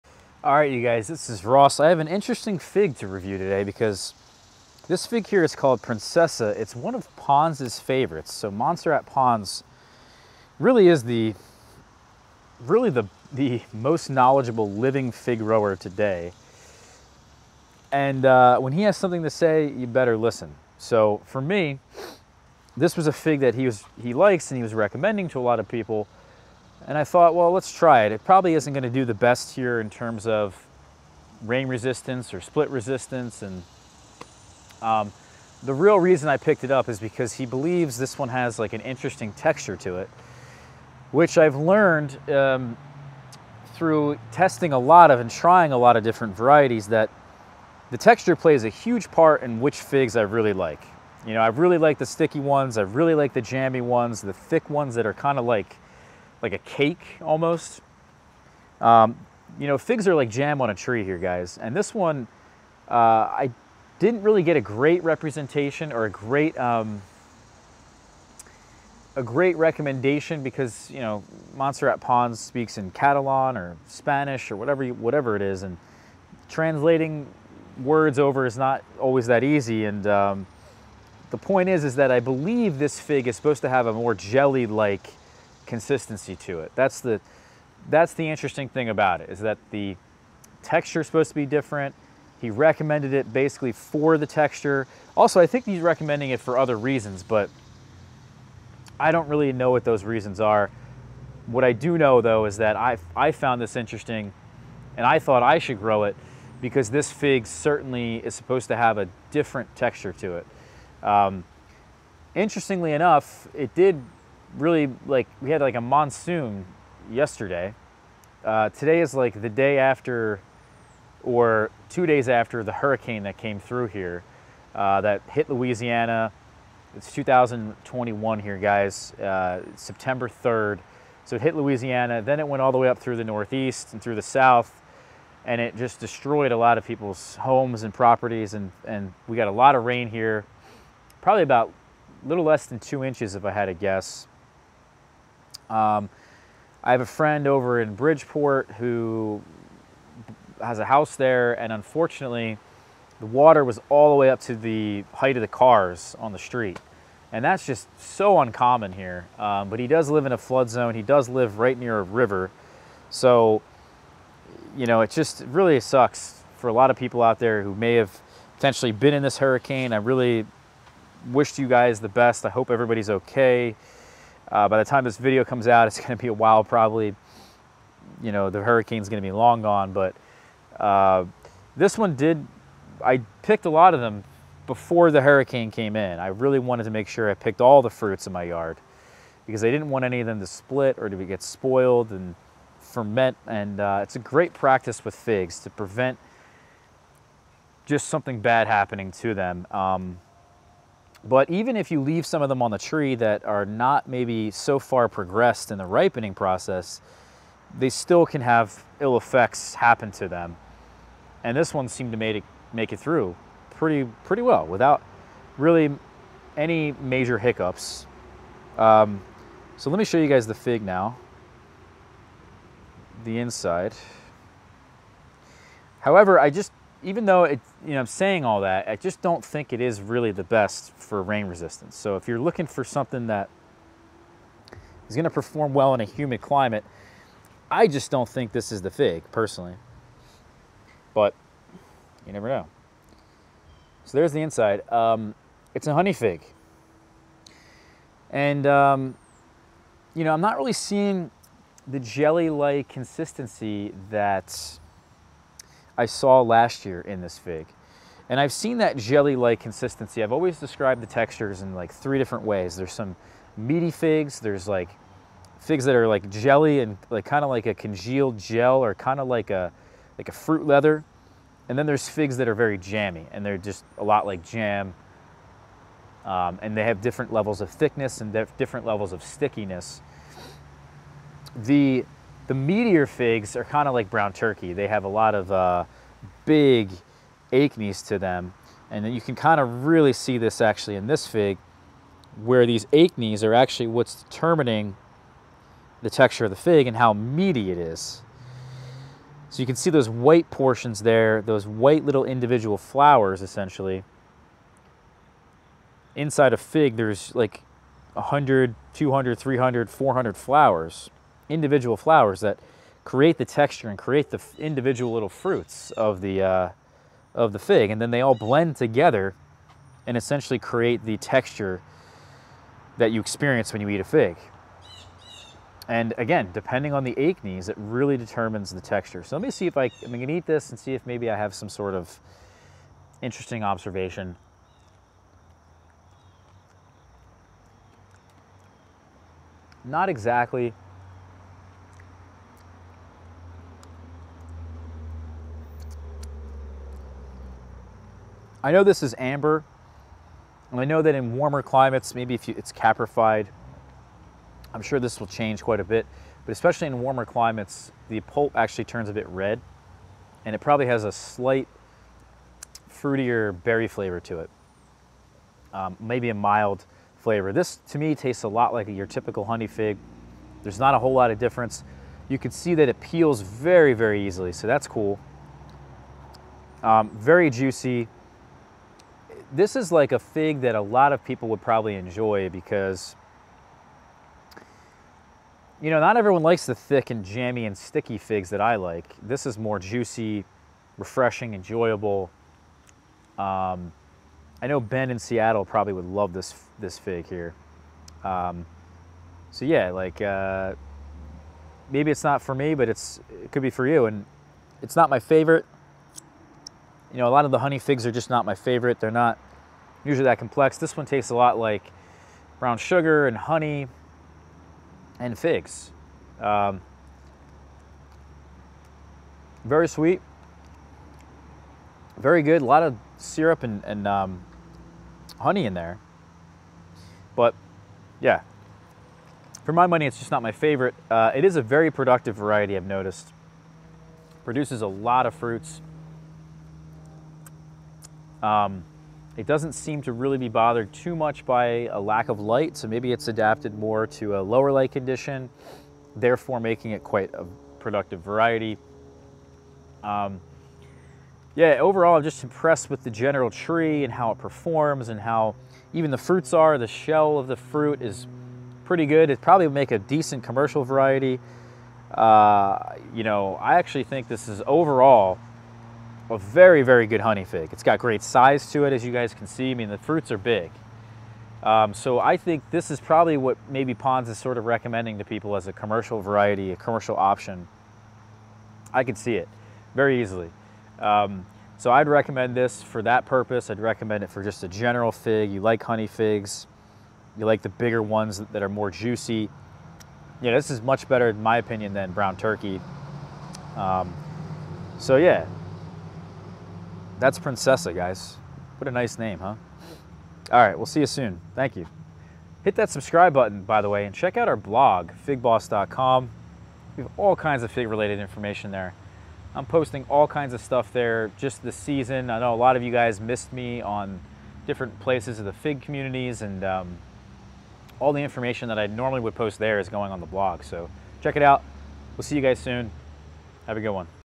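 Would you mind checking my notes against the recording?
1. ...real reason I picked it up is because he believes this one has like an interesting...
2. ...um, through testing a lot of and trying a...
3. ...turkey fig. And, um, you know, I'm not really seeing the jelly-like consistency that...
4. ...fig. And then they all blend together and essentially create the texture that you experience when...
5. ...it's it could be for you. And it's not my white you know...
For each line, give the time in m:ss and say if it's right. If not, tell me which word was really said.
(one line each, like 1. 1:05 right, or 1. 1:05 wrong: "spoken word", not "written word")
1. 0:35 right
2. 0:42 right
3. 4:05 wrong: "honey", not "turkey"
4. 5:17 right
5. 6:42 wrong: "favorite", not "white".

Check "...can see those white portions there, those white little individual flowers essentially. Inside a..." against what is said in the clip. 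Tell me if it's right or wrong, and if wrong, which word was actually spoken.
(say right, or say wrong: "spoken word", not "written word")
right.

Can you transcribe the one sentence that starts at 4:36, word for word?
Um, and they have different levels of thickness and different levels of stickiness.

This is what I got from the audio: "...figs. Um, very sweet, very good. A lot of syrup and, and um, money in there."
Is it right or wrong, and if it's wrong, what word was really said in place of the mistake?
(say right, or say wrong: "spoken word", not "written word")
wrong: "honey", not "money".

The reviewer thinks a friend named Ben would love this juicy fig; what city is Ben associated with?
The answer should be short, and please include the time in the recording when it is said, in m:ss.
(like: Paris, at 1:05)
Seattle, at 6:35.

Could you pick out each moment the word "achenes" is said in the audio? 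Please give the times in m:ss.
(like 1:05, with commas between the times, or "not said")
4:47, 4:52, 5:27.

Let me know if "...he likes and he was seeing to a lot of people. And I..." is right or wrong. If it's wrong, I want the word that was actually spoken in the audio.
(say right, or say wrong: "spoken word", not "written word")
wrong: "recommending", not "seeing".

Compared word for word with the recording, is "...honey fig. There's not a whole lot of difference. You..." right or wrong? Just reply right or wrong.
right.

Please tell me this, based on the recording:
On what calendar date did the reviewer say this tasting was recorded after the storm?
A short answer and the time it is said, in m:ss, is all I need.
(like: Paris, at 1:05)
September 3rd, at 2:09.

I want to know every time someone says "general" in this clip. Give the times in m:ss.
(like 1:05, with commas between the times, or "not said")
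7:33, 8:04.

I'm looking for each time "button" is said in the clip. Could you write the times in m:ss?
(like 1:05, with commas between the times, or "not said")
8:23.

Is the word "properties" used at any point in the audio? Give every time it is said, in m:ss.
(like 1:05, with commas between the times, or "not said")
2:17.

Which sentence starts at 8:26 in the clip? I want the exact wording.
We have all kinds of fig-related information there.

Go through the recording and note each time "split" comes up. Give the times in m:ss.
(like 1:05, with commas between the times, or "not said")
0:32, 3:10.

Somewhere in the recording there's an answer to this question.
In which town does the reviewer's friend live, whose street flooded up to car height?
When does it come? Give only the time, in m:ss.
2:27.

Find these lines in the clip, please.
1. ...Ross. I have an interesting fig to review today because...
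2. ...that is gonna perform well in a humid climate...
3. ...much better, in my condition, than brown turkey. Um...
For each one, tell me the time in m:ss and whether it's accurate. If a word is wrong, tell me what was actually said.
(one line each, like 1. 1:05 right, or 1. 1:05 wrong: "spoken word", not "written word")
1. 0:01 right
2. 3:53 right
3. 8:10 wrong: "opinion", not "condition".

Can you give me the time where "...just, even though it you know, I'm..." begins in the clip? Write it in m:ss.
3:46.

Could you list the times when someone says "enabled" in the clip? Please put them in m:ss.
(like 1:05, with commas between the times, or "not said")
not said.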